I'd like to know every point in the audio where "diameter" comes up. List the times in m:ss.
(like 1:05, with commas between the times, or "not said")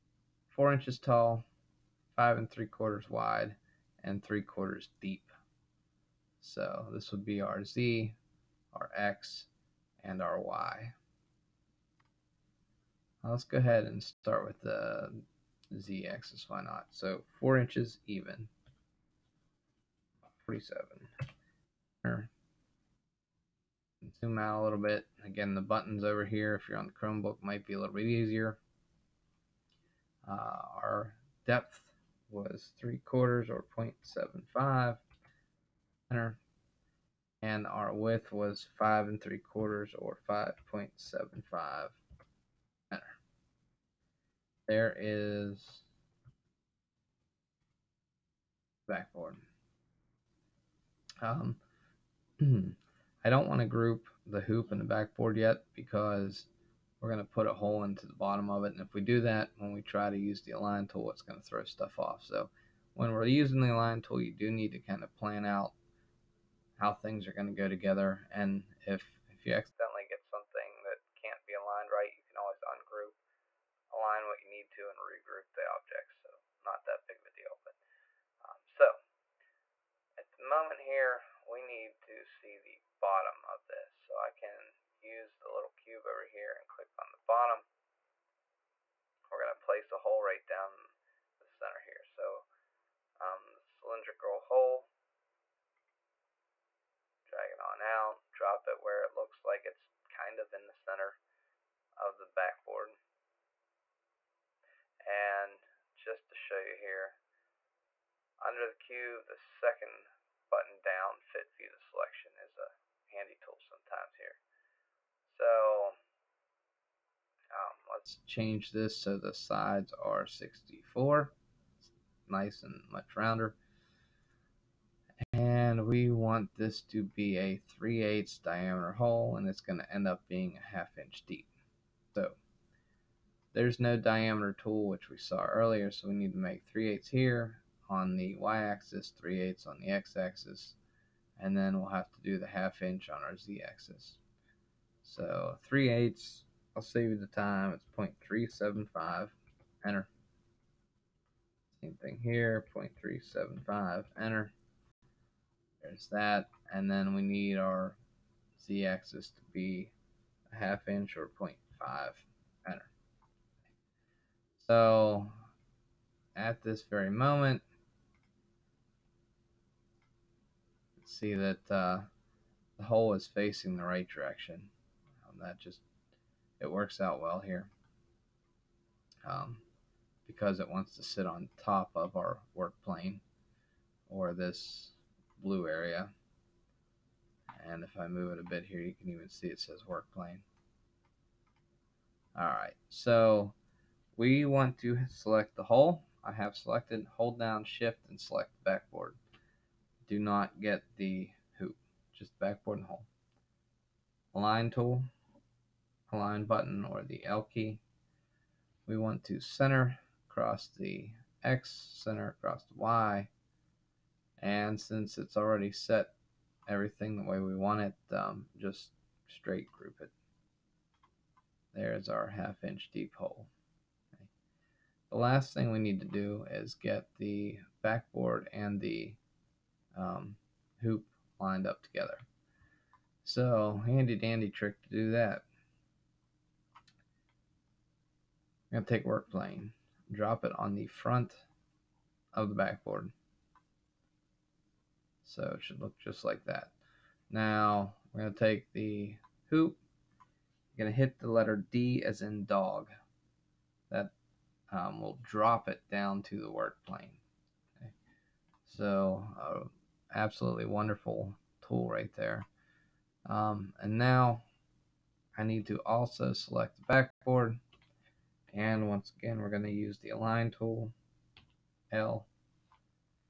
2:08, 2:13.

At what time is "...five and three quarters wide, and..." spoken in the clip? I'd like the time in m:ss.
0:02.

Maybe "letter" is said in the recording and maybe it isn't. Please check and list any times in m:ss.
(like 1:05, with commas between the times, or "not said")
4:11.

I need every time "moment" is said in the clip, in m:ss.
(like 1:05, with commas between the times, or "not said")
1:20, 2:47.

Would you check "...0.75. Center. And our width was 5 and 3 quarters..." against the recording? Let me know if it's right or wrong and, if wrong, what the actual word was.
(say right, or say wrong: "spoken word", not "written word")
right.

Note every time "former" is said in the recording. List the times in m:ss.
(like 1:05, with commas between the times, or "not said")
not said.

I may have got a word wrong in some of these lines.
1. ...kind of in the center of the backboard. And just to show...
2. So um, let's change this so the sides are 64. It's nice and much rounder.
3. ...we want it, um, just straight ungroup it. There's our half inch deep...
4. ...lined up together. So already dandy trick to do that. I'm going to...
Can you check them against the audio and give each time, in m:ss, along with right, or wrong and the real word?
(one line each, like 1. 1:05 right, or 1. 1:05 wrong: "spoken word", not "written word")
1. 1:40 right
2. 1:55 right
3. 3:37 wrong: "group", not "ungroup"
4. 3:51 wrong: "handy", not "already".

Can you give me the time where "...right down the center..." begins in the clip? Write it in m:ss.
1:30.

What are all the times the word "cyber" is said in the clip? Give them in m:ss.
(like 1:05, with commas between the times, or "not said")
not said.